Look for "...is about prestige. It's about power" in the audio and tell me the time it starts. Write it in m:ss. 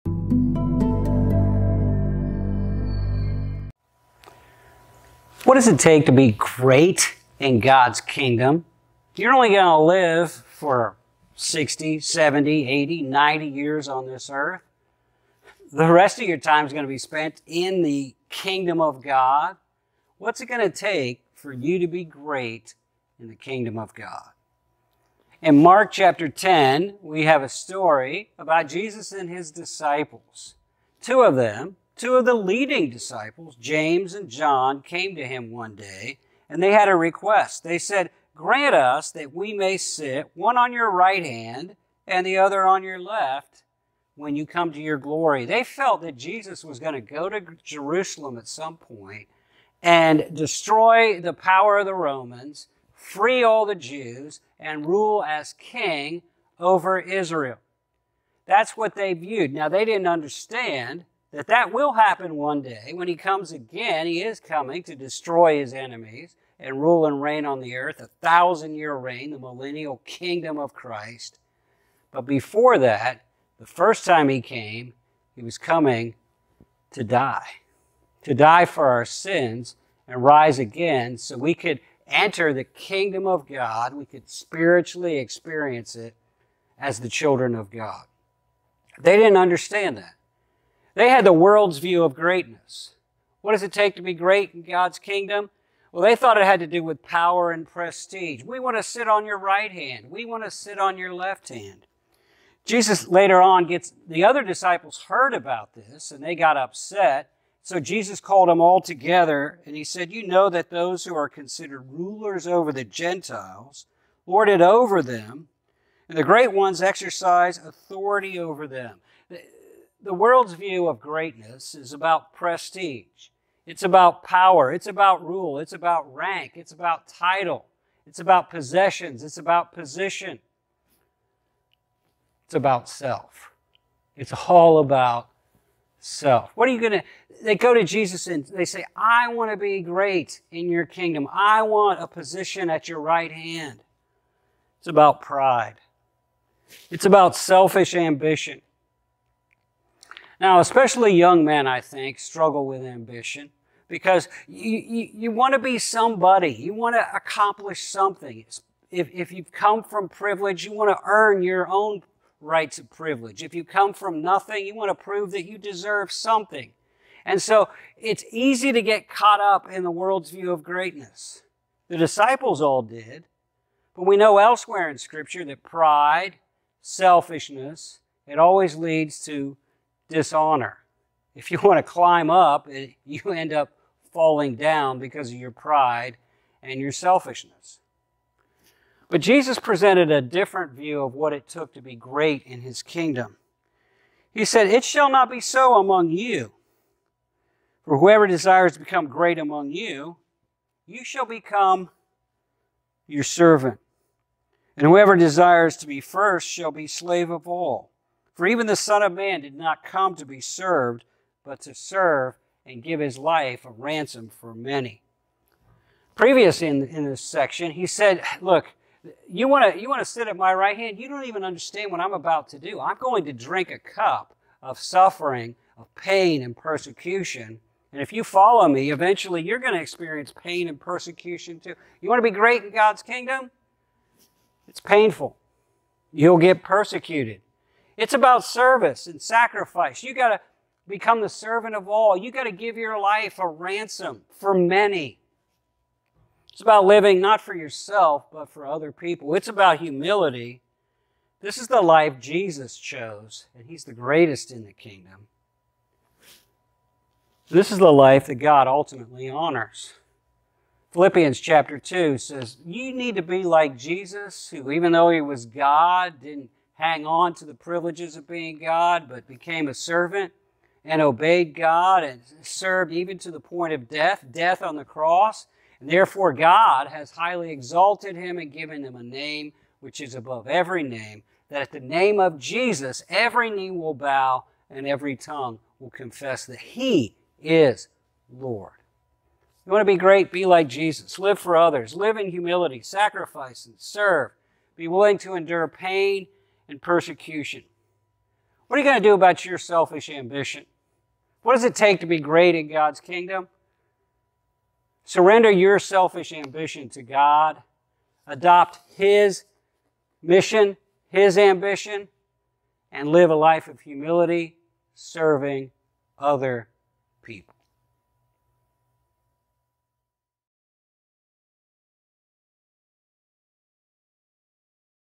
2:01.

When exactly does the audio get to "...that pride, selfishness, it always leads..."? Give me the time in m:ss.
2:55.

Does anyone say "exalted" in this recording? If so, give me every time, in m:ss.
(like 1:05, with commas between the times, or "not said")
4:37.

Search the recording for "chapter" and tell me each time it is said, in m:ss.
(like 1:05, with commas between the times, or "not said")
0:25, 4:21.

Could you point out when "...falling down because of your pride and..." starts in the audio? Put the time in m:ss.
3:04.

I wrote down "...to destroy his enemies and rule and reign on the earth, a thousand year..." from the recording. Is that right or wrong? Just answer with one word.
right.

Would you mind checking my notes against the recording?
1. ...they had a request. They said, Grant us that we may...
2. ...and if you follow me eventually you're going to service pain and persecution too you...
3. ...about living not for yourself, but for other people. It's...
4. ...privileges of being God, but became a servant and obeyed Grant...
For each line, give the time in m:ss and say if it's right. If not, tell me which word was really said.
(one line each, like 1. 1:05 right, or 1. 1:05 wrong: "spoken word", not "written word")
1. 0:36 right
2. 3:47 wrong: "experience", not "service"
3. 4:06 right
4. 4:27 wrong: "God", not "Grant".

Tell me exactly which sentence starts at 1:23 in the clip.
We could spiritually experience it as the children of God.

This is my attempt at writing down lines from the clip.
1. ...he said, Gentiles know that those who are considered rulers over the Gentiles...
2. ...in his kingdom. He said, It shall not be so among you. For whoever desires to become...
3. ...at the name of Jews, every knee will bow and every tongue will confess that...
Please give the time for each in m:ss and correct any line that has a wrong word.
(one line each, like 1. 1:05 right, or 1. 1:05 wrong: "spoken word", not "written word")
1. 1:49 wrong: "You", not "Gentiles"
2. 3:12 right
3. 4:41 wrong: "Jesus", not "Jews".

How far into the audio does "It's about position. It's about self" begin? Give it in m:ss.
2:09.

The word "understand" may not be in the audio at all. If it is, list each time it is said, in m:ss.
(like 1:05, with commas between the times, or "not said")
1:00, 1:29, 3:41.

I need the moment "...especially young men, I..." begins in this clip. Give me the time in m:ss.
2:30.